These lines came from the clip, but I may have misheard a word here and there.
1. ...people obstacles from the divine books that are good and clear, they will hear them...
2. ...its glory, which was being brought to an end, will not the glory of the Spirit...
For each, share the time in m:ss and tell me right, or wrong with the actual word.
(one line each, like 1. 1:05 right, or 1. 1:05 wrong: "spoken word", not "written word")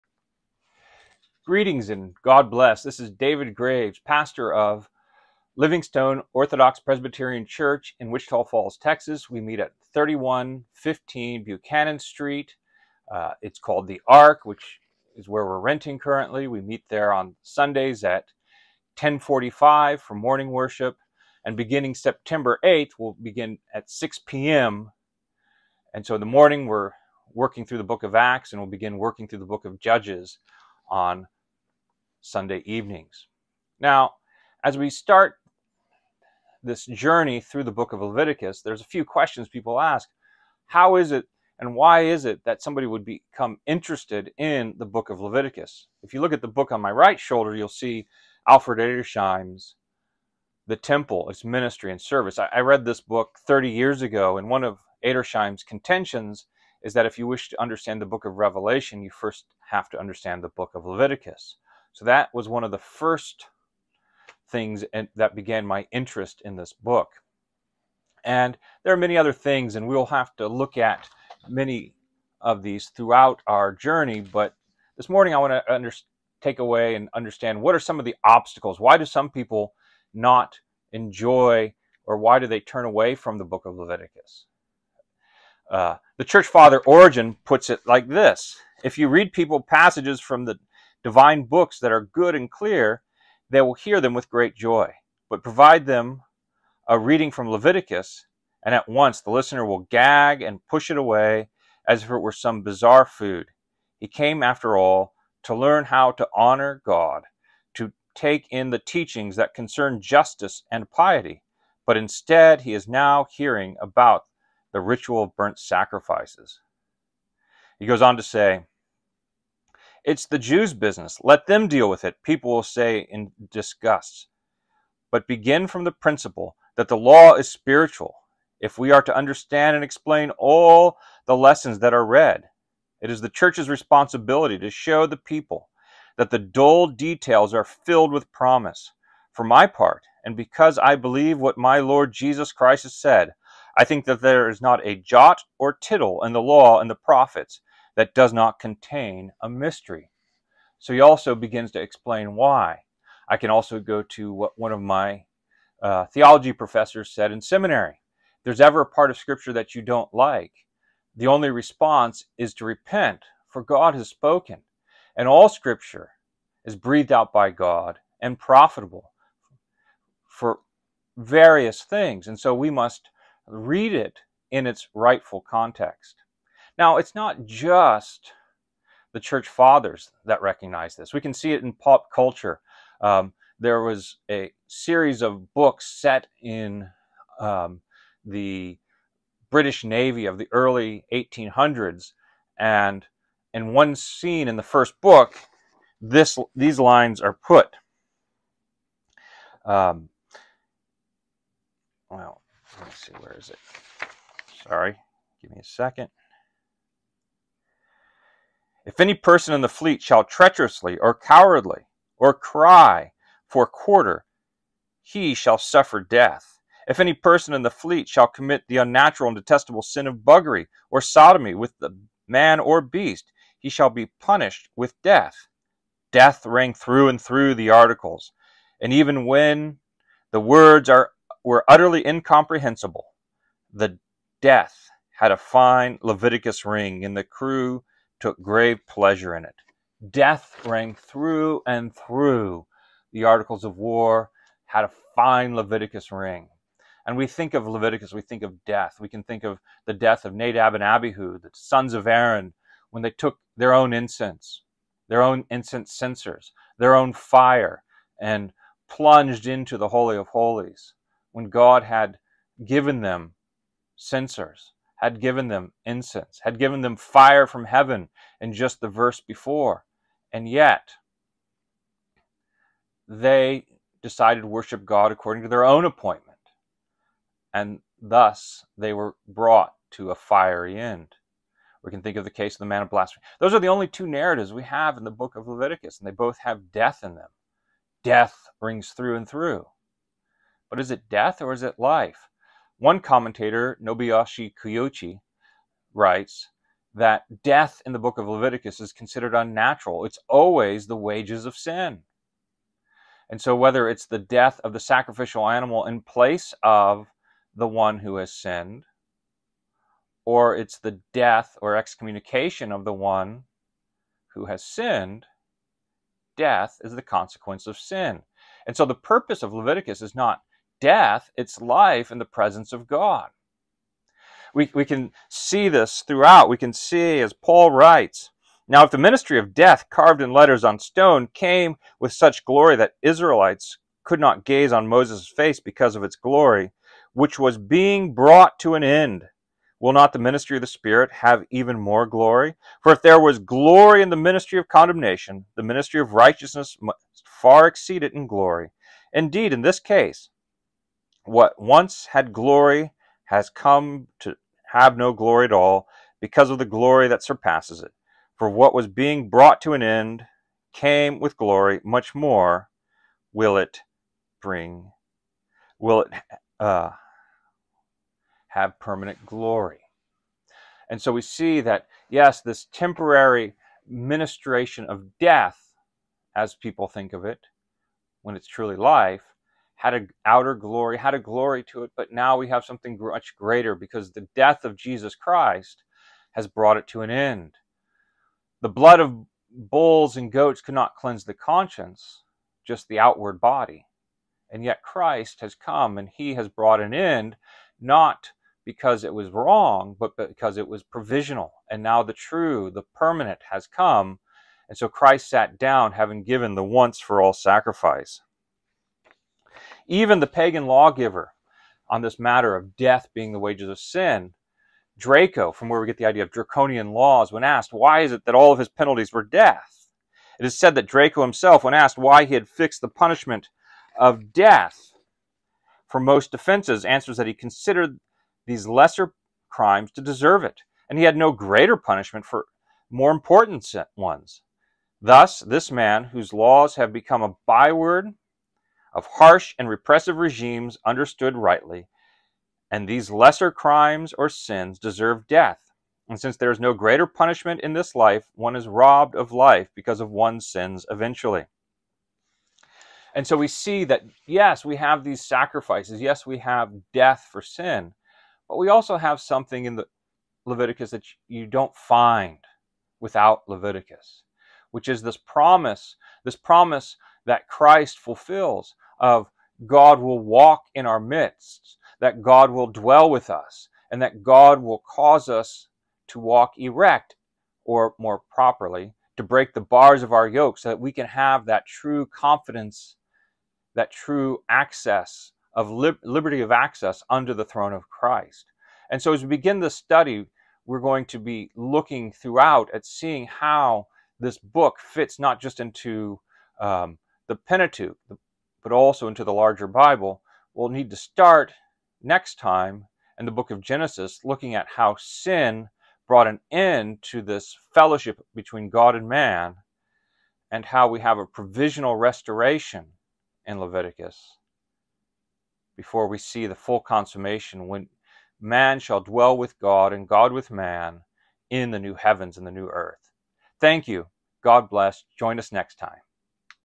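1. 1:29 wrong: "passages", not "obstacles"
2. 5:36 wrong: "ministry", not "glory".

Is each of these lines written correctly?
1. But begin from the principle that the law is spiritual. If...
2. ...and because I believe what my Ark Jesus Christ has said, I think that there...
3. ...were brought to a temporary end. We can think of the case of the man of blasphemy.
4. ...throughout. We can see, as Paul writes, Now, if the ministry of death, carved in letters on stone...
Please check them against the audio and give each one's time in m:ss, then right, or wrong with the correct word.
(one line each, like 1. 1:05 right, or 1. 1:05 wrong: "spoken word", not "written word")
1. 2:05 right
2. 2:20 wrong: "Lord", not "Ark"
3. 4:38 wrong: "fiery", not "temporary"
4. 5:26 right.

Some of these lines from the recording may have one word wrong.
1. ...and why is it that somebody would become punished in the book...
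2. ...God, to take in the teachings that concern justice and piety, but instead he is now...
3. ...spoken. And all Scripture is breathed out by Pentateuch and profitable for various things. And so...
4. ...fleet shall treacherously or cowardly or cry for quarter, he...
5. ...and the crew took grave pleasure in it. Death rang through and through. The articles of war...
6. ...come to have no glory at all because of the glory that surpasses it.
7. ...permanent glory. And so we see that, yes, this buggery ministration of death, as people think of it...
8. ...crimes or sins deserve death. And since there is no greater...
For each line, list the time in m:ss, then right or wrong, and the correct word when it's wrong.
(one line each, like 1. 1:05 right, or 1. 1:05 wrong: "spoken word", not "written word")
1. 0:41 wrong: "interested", not "punished"
2. 1:46 right
3. 2:44 wrong: "God", not "Pentateuch"
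4. 3:29 right
5. 3:57 right
6. 5:53 right
7. 6:08 wrong: "temporary", not "buggery"
8. 7:23 right.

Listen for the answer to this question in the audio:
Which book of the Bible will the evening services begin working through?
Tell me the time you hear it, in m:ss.
0:29.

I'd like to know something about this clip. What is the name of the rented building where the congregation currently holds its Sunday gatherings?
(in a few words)
The Ark.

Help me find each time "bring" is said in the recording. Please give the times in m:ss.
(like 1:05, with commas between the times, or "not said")
6:04.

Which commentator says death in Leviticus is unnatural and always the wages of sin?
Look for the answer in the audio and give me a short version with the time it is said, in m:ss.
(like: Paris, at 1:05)
Nobuyoshi Kiuchi, at 4:53.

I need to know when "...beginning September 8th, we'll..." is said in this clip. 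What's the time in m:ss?
0:21.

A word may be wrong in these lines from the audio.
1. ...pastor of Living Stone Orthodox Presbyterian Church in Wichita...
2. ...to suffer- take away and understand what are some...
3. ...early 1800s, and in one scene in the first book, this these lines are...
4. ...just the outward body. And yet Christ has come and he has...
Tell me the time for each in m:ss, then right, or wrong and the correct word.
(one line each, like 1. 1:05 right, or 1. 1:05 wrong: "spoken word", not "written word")
1. 0:03 right
2. 1:15 wrong: "under", not "suffer"
3. 3:10 right
4. 6:32 right.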